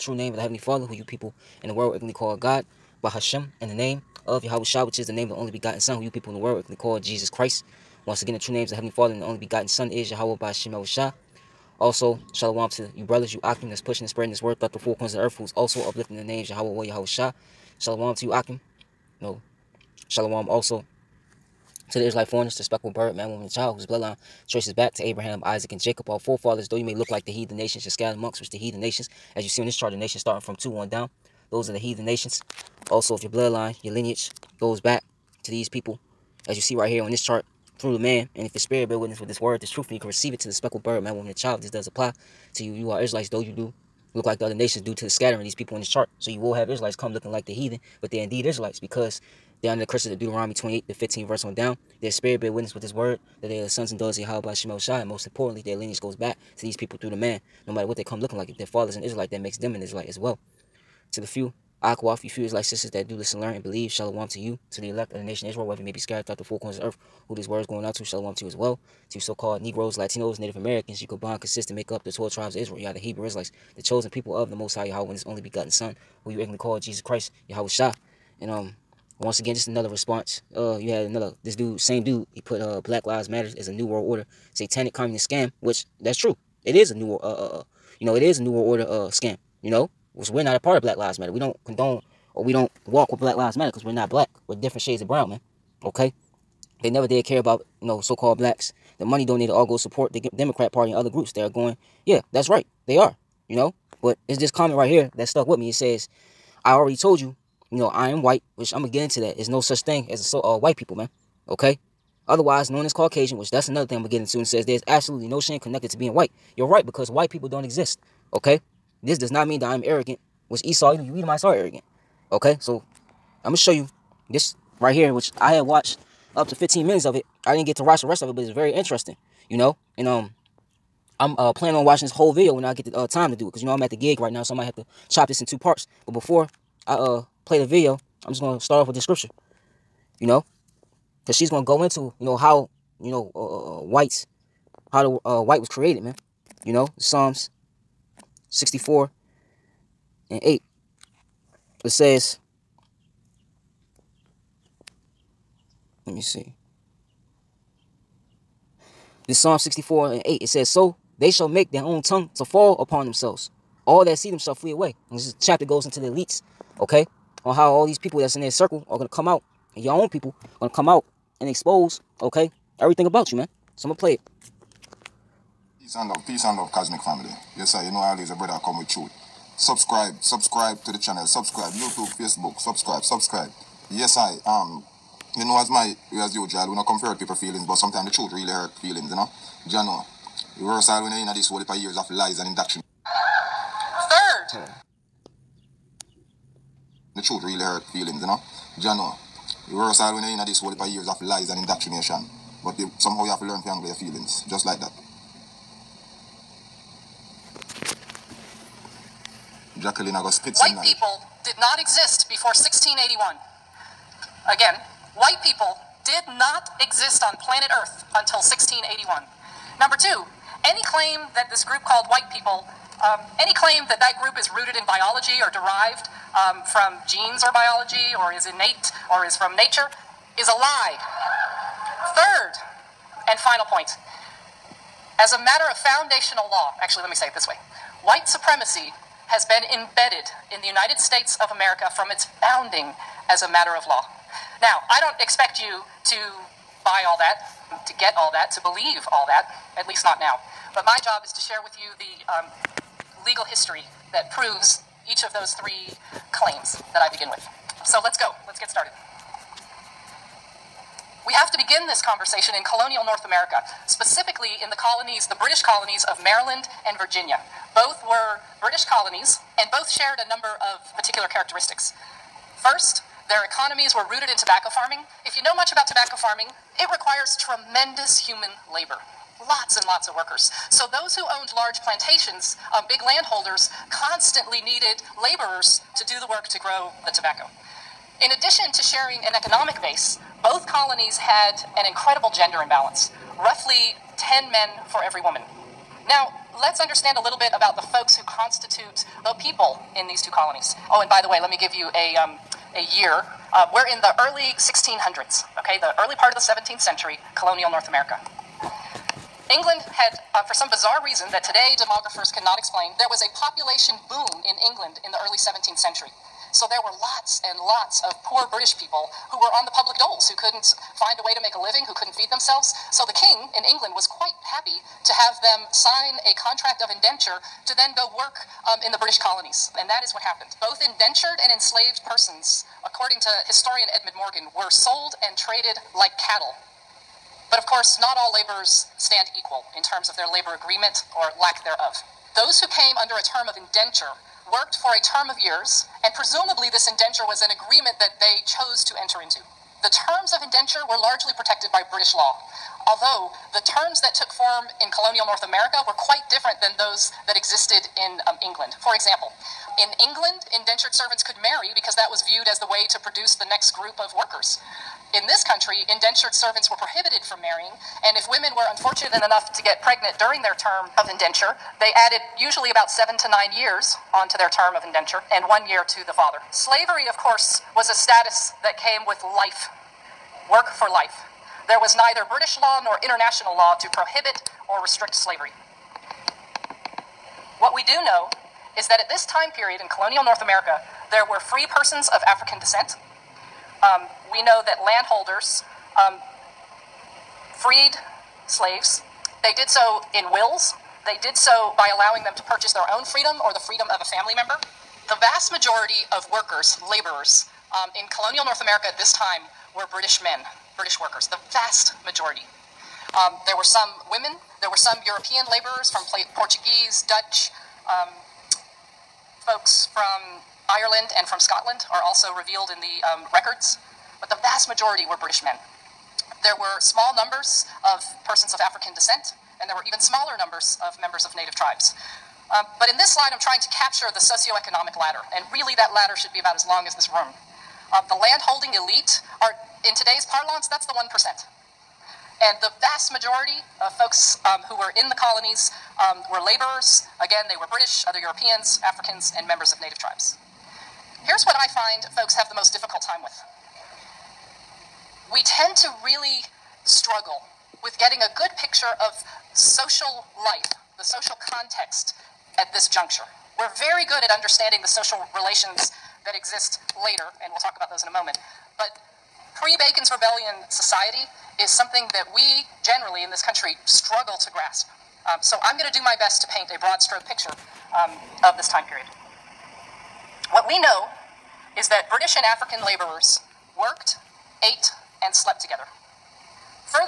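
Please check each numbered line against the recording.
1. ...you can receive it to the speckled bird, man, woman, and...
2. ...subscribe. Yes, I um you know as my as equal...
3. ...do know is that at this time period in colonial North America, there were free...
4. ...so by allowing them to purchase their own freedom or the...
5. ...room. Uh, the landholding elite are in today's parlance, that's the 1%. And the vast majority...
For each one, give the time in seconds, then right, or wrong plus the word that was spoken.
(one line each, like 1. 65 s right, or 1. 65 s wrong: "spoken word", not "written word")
1. 39 s right
2. 183 s wrong: "usual", not "equal"
3. 387 s right
4. 401 s right
5. 437 s right.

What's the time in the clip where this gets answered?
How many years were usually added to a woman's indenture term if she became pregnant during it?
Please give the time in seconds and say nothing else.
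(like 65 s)
372 s.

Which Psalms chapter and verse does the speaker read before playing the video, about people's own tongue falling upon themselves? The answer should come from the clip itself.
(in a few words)
Psalms 64:8.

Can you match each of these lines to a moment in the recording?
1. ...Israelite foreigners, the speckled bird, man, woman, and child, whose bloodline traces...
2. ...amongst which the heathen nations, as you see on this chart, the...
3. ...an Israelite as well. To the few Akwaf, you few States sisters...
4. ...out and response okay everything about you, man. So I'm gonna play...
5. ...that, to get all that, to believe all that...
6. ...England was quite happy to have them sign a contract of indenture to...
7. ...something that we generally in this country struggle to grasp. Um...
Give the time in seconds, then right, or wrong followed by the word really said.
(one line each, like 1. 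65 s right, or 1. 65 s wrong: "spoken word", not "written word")
1. 22 s right
2. 28 s right
3. 59 s wrong: "Israelite", not "States"
4. 170 s wrong: "expose", not "response"
5. 247 s right
6. 323 s right
7. 471 s right.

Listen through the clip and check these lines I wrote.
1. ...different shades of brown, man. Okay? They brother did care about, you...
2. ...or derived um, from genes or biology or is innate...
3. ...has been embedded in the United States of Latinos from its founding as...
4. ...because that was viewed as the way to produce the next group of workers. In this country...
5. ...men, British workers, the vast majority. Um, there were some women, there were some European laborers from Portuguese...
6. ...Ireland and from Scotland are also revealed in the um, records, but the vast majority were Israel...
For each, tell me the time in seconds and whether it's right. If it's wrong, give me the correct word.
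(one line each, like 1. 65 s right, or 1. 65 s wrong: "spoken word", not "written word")
1. 94 s wrong: "never", not "brother"
2. 225 s right
3. 239 s wrong: "America", not "Latinos"
4. 361 s right
5. 410 s right
6. 420 s wrong: "British", not "Israel".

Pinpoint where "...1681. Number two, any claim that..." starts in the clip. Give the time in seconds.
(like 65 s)
218 s.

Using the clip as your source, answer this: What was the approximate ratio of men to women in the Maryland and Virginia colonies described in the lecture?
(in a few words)
10 men per woman.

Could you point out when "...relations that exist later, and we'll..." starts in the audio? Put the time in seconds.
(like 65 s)
465 s.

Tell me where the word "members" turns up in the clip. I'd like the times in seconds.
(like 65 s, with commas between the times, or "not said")
404 s, 430 s, 449 s.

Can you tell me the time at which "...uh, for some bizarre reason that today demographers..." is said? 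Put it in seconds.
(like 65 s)
310 s.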